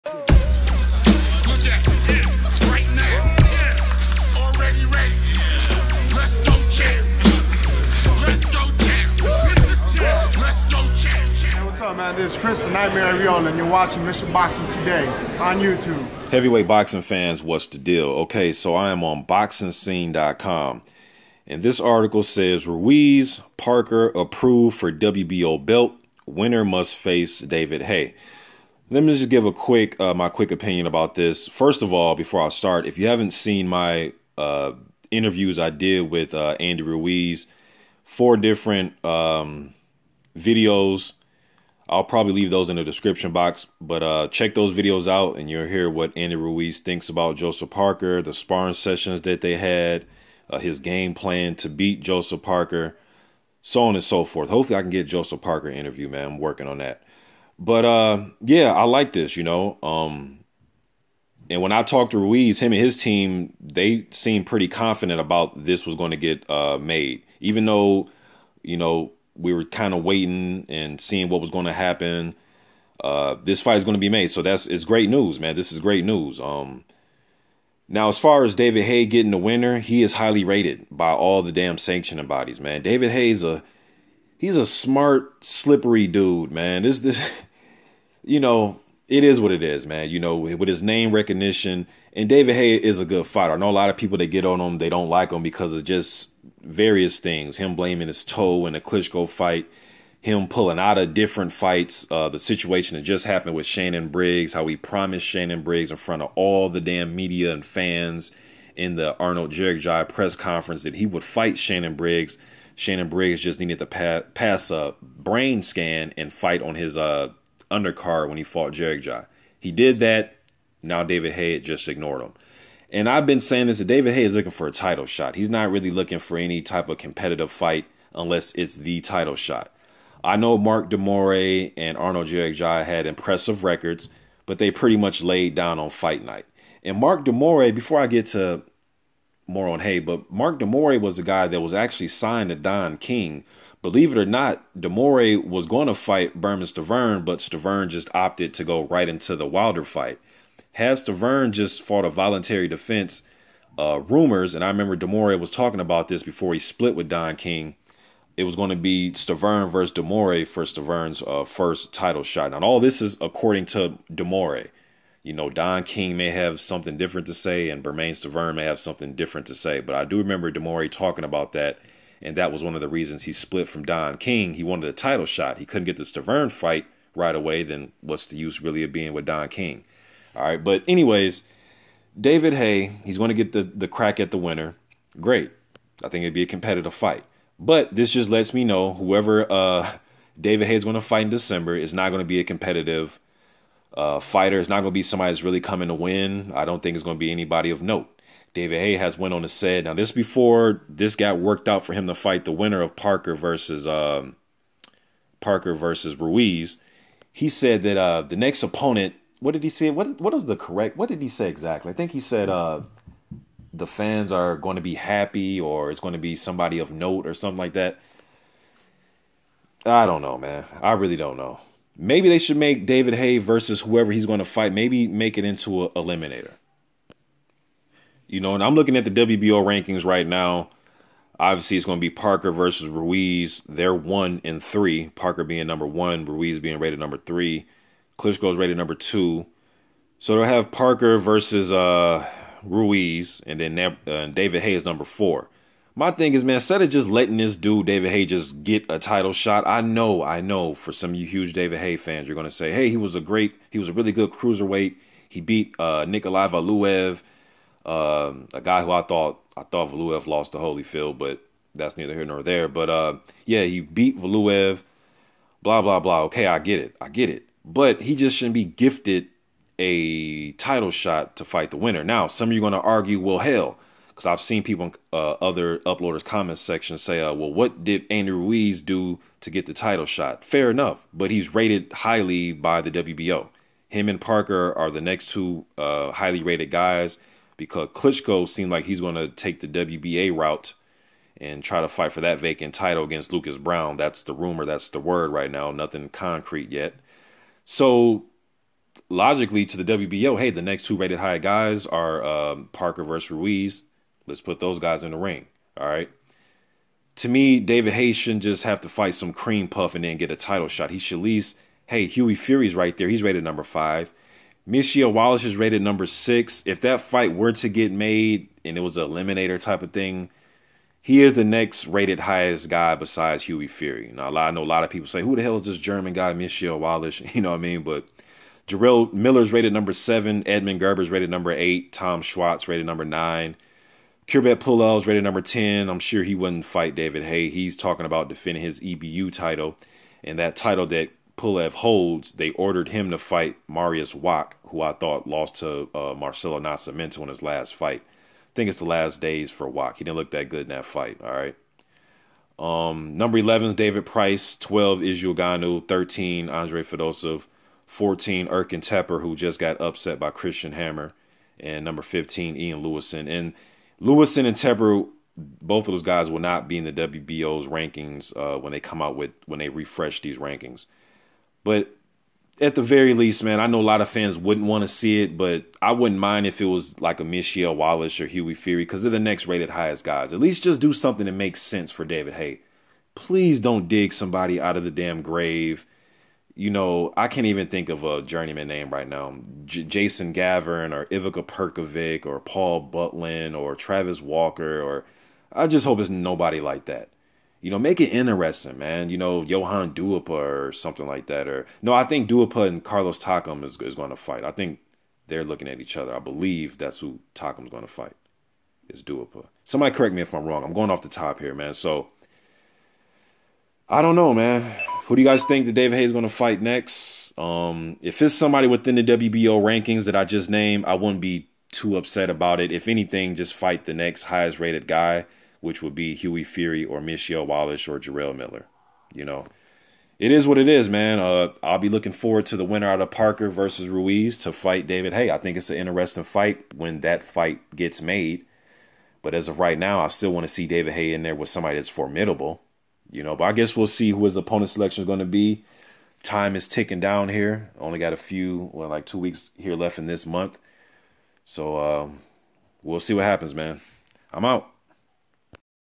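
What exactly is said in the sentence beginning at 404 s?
I think they're looking at each other.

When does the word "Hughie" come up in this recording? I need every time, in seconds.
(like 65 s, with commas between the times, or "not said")
312 s, 323 s, 378 s, 426 s.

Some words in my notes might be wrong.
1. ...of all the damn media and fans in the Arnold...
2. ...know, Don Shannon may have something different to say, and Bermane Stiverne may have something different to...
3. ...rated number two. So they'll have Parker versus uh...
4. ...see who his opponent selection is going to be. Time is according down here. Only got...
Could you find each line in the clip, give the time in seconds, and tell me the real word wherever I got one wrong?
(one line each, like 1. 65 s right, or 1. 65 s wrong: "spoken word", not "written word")
1. 106 s right
2. 165 s wrong: "King", not "Shannon"
3. 238 s right
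4. 443 s wrong: "ticking", not "according".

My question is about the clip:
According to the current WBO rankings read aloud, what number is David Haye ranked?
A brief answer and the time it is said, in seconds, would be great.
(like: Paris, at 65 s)
4, at 244 s.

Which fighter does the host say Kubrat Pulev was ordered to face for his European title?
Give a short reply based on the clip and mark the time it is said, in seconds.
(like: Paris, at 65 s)
Mariusz Wach, at 343 s.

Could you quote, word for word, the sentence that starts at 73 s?
Uh, this fight is going to be made, so that's it's great news, man.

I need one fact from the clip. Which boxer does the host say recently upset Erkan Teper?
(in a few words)
Christian Hammer.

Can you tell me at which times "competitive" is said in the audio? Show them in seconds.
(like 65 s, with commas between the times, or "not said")
126 s, 186 s, 192 s.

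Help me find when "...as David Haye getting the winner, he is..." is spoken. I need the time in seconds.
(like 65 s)
78 s.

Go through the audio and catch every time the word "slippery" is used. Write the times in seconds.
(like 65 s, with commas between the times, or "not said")
85 s.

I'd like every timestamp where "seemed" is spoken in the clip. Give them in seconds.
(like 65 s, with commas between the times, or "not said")
64 s, 288 s.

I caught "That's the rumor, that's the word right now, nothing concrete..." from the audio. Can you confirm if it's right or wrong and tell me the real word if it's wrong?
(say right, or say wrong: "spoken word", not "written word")
right.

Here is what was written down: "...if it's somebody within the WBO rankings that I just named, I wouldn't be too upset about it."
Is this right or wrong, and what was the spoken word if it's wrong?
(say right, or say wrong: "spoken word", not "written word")
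right.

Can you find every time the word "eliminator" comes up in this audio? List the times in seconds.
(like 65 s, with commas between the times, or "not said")
225 s, 319 s.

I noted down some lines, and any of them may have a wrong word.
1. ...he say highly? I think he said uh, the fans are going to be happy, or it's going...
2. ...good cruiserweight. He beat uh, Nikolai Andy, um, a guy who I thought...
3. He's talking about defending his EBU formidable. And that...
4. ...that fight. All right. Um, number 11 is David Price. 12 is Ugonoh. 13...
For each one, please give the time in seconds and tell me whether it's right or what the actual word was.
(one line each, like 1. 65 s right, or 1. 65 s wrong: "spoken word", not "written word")
1. 211 s wrong: "exactly", not "highly"
2. 254 s wrong: "Valuev", not "Andy"
3. 337 s wrong: "title", not "formidable"
4. 350 s right.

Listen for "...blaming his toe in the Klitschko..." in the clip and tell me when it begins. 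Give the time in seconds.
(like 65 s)
97 s.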